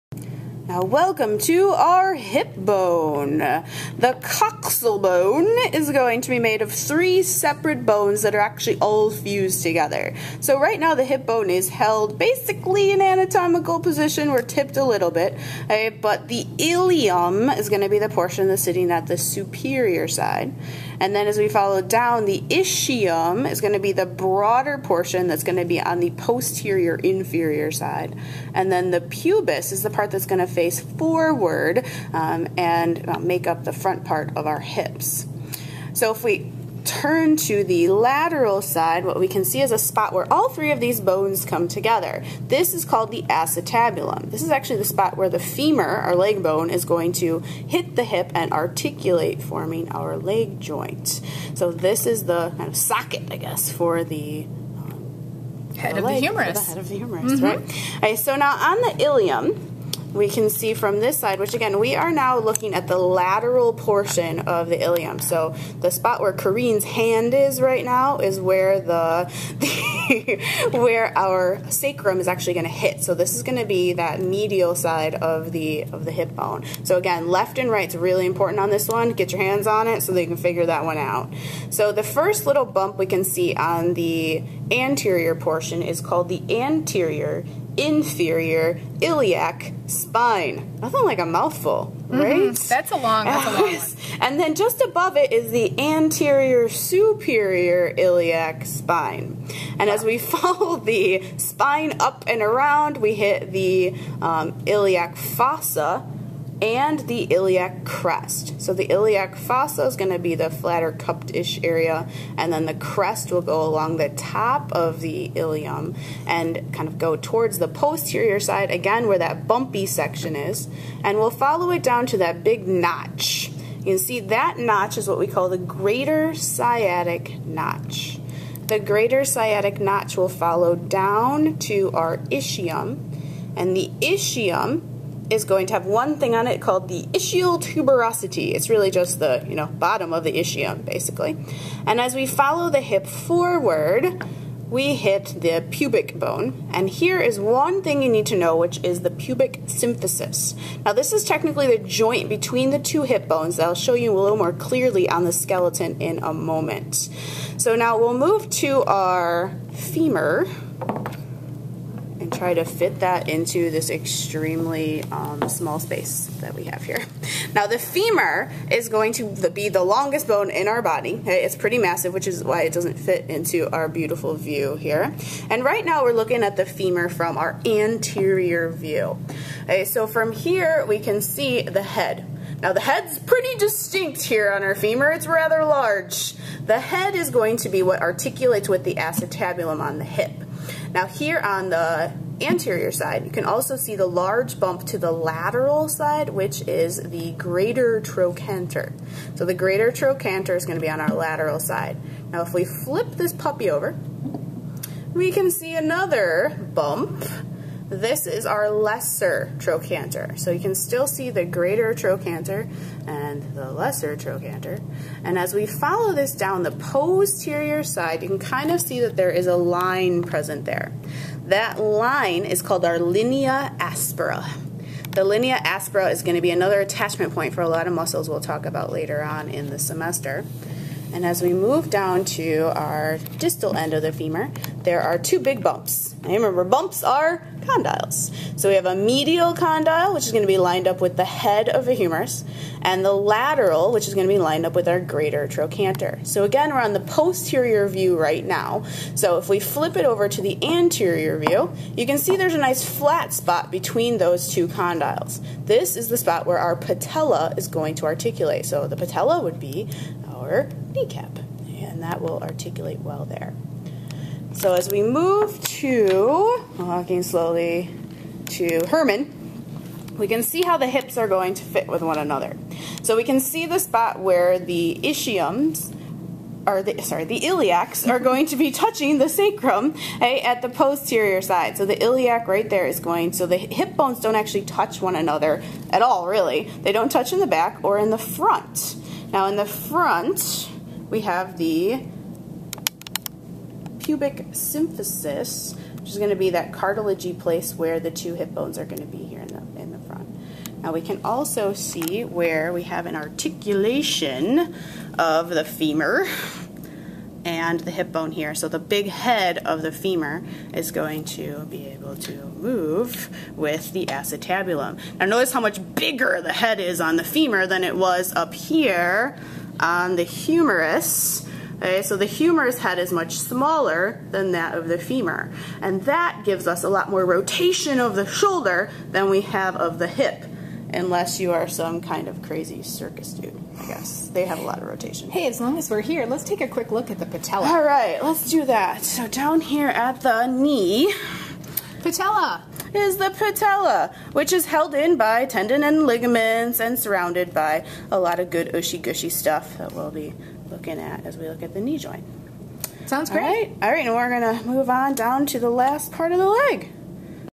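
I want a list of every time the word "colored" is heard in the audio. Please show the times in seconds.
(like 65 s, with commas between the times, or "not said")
not said.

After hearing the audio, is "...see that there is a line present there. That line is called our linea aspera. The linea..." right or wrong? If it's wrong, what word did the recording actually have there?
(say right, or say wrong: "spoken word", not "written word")
right.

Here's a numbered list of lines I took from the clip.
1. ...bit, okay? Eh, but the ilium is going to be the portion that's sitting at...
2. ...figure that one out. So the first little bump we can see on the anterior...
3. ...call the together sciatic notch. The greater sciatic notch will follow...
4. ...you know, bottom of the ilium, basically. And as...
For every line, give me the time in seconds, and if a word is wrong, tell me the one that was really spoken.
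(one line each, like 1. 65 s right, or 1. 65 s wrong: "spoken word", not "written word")
1. 15 s right
2. 80 s right
3. 125 s wrong: "greater", not "together"
4. 139 s wrong: "ischium", not "ilium".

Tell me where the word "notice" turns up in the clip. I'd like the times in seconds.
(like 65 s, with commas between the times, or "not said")
315 s.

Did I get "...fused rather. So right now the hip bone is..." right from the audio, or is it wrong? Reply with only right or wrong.
wrong.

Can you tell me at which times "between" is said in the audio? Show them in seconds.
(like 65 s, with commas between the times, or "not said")
152 s, 253 s.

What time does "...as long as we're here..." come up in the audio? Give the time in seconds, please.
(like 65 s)
335 s.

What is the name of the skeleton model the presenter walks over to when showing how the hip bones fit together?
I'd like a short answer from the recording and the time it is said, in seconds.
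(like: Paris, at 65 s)
Herman, at 268 s.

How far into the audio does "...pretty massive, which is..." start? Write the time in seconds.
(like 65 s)
171 s.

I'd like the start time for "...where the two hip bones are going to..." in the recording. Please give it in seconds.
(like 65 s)
297 s.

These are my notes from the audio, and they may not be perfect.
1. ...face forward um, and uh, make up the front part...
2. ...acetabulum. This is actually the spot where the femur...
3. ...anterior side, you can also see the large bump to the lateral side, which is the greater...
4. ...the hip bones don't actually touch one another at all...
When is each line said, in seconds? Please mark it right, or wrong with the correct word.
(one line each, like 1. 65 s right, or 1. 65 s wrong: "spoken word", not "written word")
1. 30 s right
2. 43 s right
3. 192 s right
4. 283 s right.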